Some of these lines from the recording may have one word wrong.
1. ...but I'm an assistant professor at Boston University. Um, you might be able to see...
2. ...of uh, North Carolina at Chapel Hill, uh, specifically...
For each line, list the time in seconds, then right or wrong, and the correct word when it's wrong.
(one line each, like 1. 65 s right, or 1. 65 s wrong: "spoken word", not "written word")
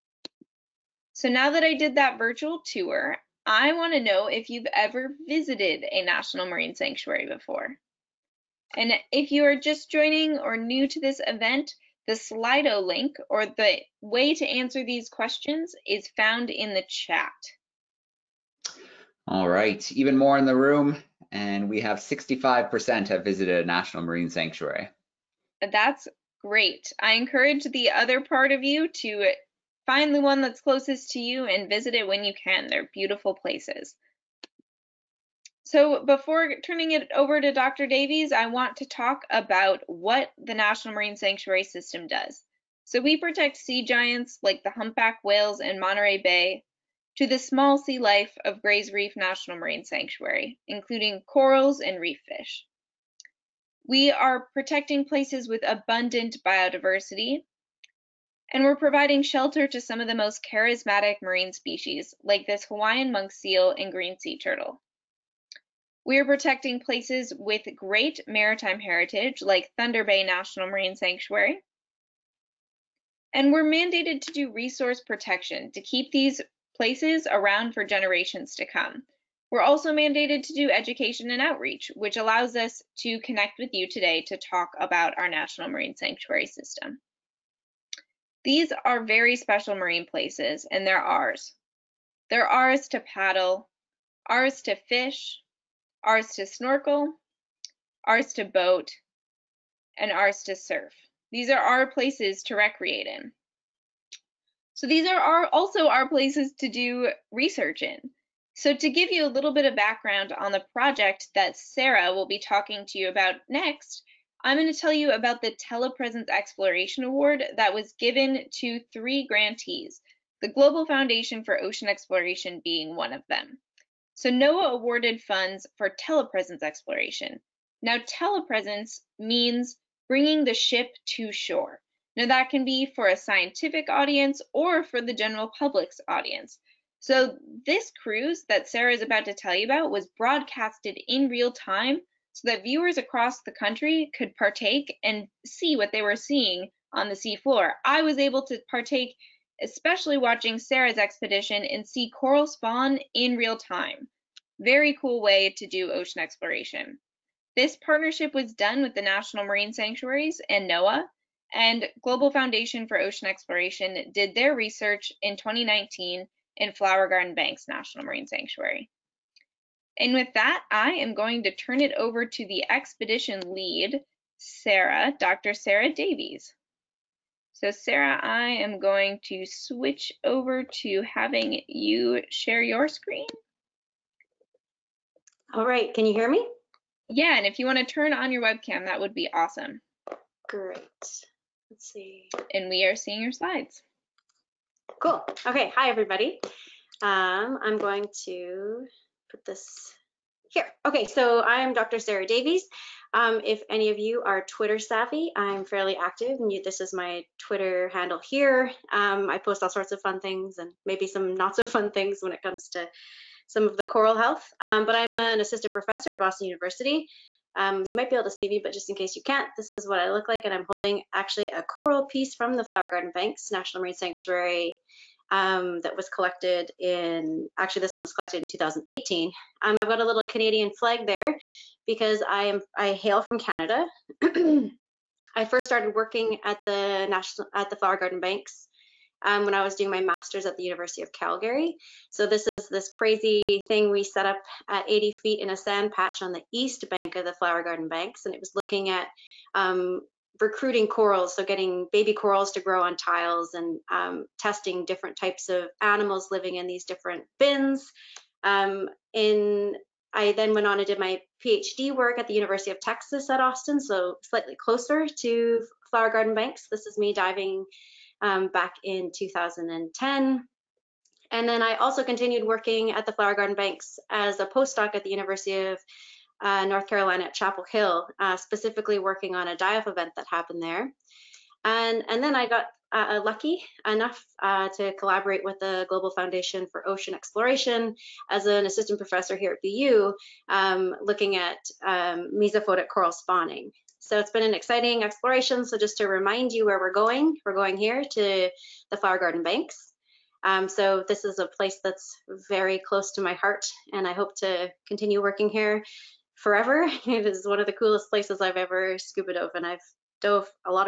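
1. 214 s right
2. 275 s right.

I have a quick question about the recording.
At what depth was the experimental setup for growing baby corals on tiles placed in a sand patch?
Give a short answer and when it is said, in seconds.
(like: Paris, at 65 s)
80 feet, at 244 s.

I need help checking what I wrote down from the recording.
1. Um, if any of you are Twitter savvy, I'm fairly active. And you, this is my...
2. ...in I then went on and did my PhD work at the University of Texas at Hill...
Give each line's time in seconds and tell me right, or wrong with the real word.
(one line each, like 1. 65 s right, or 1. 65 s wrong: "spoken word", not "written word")
1. 203 s right
2. 259 s wrong: "Austin", not "Hill".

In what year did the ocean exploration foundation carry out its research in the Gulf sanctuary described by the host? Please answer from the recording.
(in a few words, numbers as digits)
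2019.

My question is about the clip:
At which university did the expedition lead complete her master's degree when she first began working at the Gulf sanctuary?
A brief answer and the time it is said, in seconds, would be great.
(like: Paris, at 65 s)
University of Calgary, at 240 s.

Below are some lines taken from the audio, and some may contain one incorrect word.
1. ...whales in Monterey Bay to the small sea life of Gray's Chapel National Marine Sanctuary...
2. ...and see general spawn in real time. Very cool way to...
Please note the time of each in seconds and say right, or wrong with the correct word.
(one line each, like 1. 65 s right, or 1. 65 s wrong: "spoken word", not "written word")
1. 45 s wrong: "Reef", not "Chapel"
2. 151 s wrong: "coral", not "general".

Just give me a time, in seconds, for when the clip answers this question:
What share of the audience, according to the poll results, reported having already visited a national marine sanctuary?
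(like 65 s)
21 s.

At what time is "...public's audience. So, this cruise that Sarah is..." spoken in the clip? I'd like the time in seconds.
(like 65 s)
135 s.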